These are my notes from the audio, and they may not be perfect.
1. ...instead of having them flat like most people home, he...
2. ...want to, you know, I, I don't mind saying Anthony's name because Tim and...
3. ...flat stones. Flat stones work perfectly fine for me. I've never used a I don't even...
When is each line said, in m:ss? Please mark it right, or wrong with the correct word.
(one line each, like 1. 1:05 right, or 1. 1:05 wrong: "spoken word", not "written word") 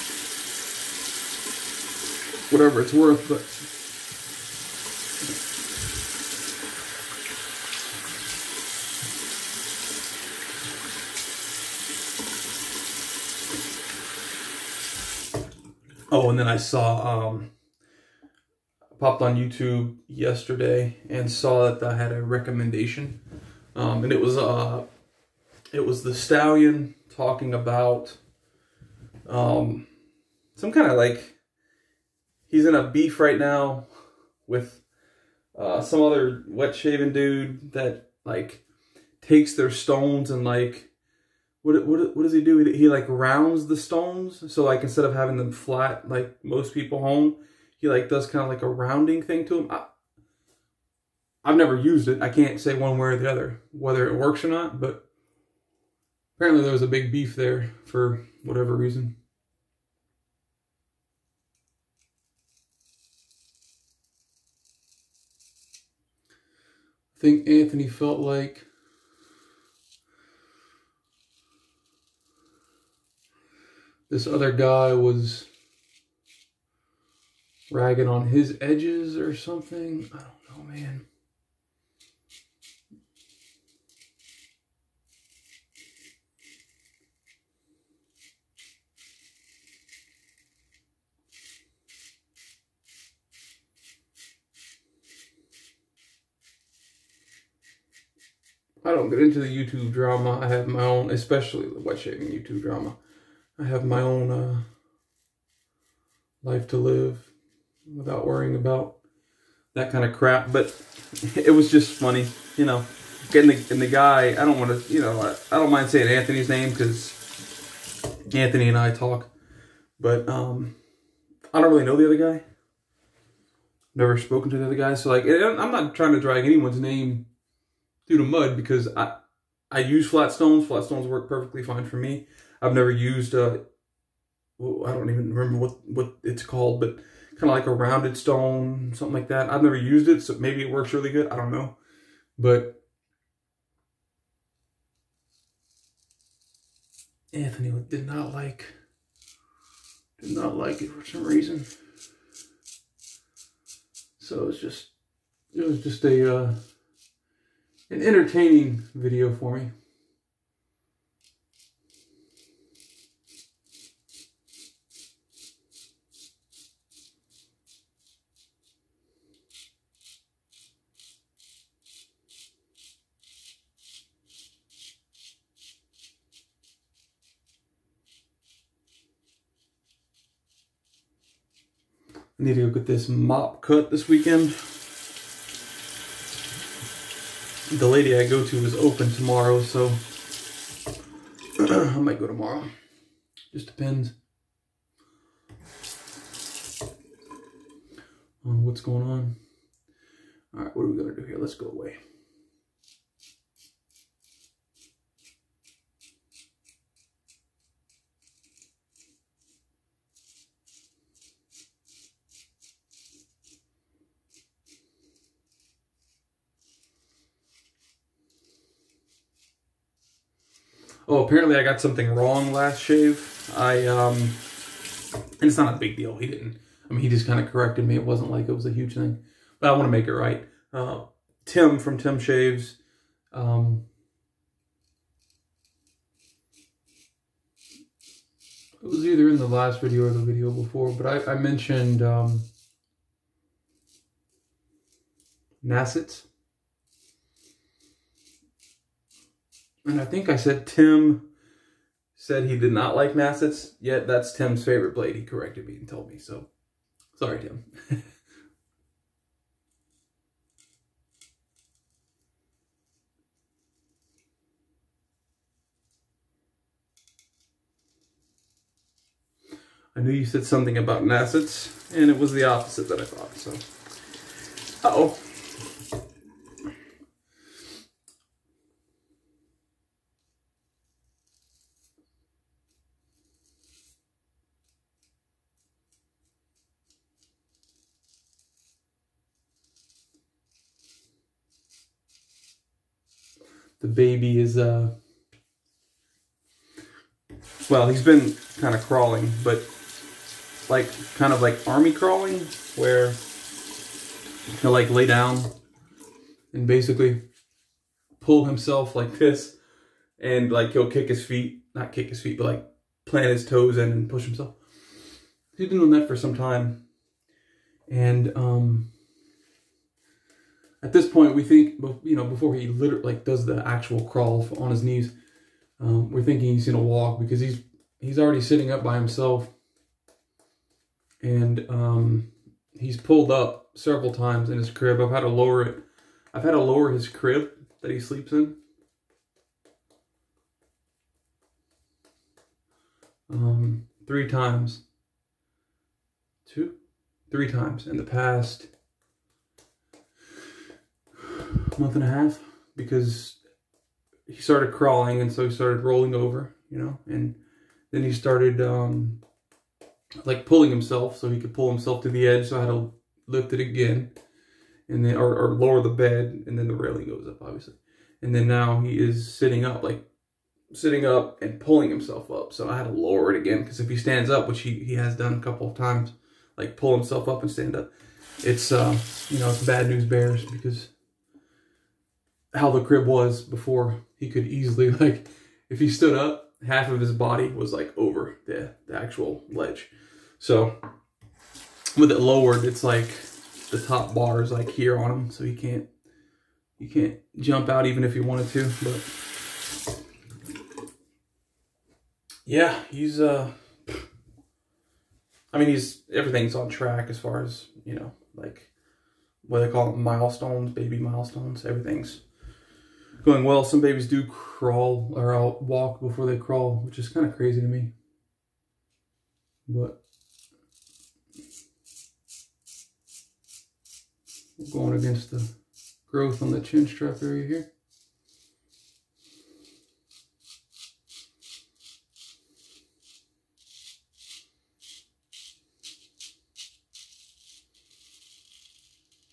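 1. 0:44 right
2. 1:54 wrong: "Anthony", not "Tim"
3. 2:10 right.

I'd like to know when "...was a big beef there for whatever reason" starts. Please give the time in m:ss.
0:56.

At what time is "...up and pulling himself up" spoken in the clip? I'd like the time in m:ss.
6:11.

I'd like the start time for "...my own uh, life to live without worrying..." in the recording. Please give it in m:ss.
1:43.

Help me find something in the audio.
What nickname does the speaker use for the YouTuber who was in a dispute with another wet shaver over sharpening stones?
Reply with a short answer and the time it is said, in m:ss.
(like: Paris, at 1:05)
the stallion, at 0:26.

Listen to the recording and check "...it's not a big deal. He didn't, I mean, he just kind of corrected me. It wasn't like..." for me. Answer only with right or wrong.
right.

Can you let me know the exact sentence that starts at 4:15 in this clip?
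He corrected me and told me, so sorry, Tim.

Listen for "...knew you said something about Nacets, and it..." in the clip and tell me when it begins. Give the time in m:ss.
4:30.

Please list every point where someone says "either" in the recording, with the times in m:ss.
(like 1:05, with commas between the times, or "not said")
3:59.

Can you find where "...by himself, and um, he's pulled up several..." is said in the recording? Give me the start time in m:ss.
5:28.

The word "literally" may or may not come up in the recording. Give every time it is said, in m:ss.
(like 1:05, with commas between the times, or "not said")
5:22.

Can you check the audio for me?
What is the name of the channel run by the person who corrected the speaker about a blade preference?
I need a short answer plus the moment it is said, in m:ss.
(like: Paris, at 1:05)
Tim Shaves, at 3:51.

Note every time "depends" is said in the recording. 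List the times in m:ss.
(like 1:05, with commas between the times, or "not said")
3:13.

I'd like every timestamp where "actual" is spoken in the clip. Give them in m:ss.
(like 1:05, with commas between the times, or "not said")
5:23, 6:28.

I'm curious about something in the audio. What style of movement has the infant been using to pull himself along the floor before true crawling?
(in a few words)
army crawling.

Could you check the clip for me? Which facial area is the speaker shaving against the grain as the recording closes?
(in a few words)
chin strap area.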